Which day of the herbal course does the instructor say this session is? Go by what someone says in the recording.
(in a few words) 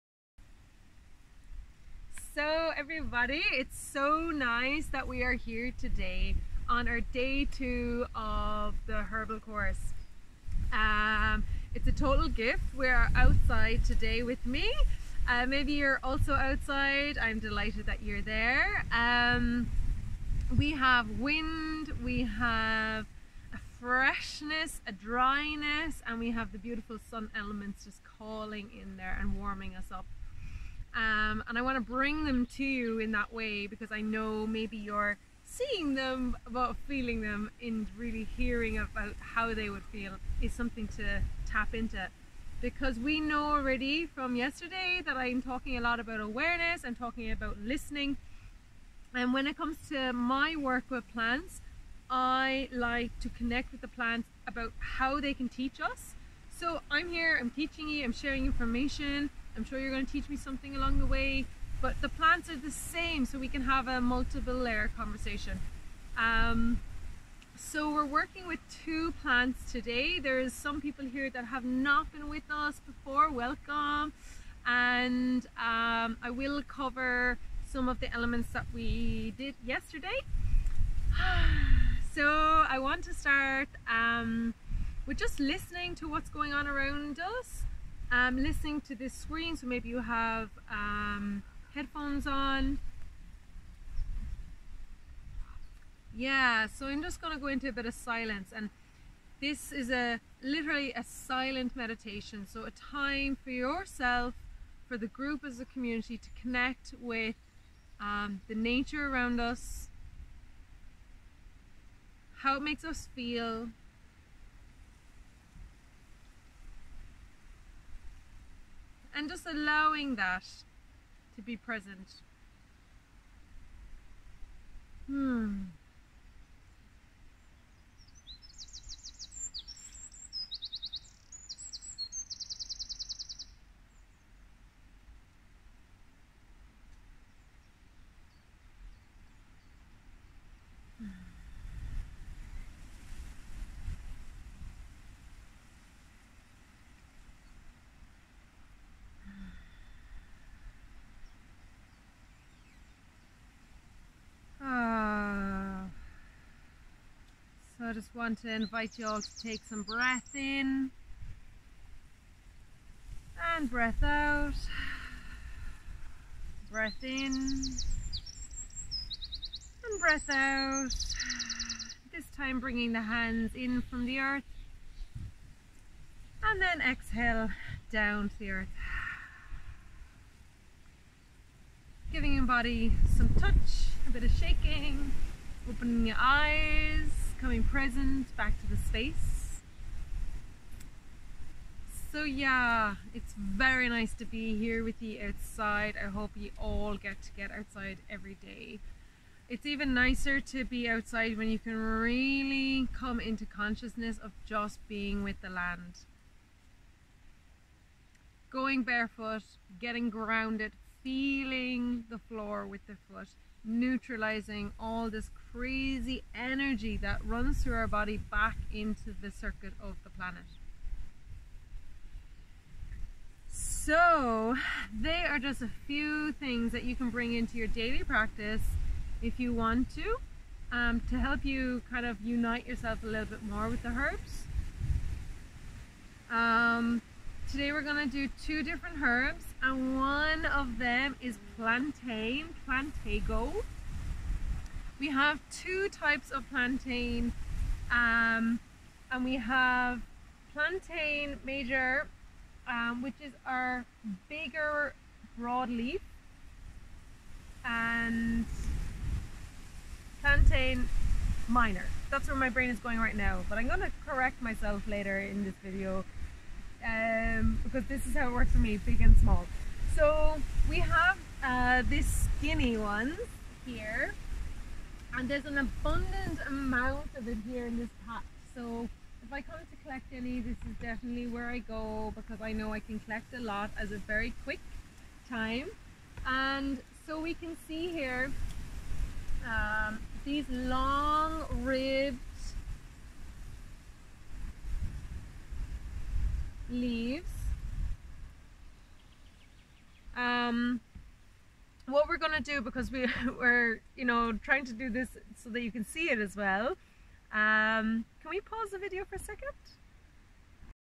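Day 2.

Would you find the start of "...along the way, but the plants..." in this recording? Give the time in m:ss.
1:00.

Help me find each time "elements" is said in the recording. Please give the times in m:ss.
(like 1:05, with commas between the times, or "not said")
0:27, 1:18.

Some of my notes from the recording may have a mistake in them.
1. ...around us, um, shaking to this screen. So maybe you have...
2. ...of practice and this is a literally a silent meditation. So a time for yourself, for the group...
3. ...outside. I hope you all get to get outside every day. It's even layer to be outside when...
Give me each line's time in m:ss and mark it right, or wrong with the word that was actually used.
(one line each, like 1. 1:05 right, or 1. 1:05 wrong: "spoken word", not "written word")
1. 1:26 wrong: "listening", not "shaking"
2. 1:37 wrong: "silence", not "practice"
3. 3:15 wrong: "nicer", not "layer".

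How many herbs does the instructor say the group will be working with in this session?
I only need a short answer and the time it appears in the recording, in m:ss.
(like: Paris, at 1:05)
2, at 1:08.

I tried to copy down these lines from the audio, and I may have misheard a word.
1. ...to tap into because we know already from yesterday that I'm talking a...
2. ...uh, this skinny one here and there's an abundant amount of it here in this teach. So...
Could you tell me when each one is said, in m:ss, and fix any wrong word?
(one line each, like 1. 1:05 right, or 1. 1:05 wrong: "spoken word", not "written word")
1. 0:40 right
2. 4:31 wrong: "patch", not "teach".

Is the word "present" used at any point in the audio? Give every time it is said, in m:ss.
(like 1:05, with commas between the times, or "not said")
2:01, 3:07.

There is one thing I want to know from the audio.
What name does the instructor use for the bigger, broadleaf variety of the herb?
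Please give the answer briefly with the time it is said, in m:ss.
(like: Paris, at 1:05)
Plantain major, at 4:10.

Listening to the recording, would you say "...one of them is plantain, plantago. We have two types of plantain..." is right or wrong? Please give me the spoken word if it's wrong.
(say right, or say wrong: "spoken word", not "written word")
right.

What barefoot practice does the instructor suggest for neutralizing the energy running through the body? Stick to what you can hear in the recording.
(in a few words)
Getting grounded.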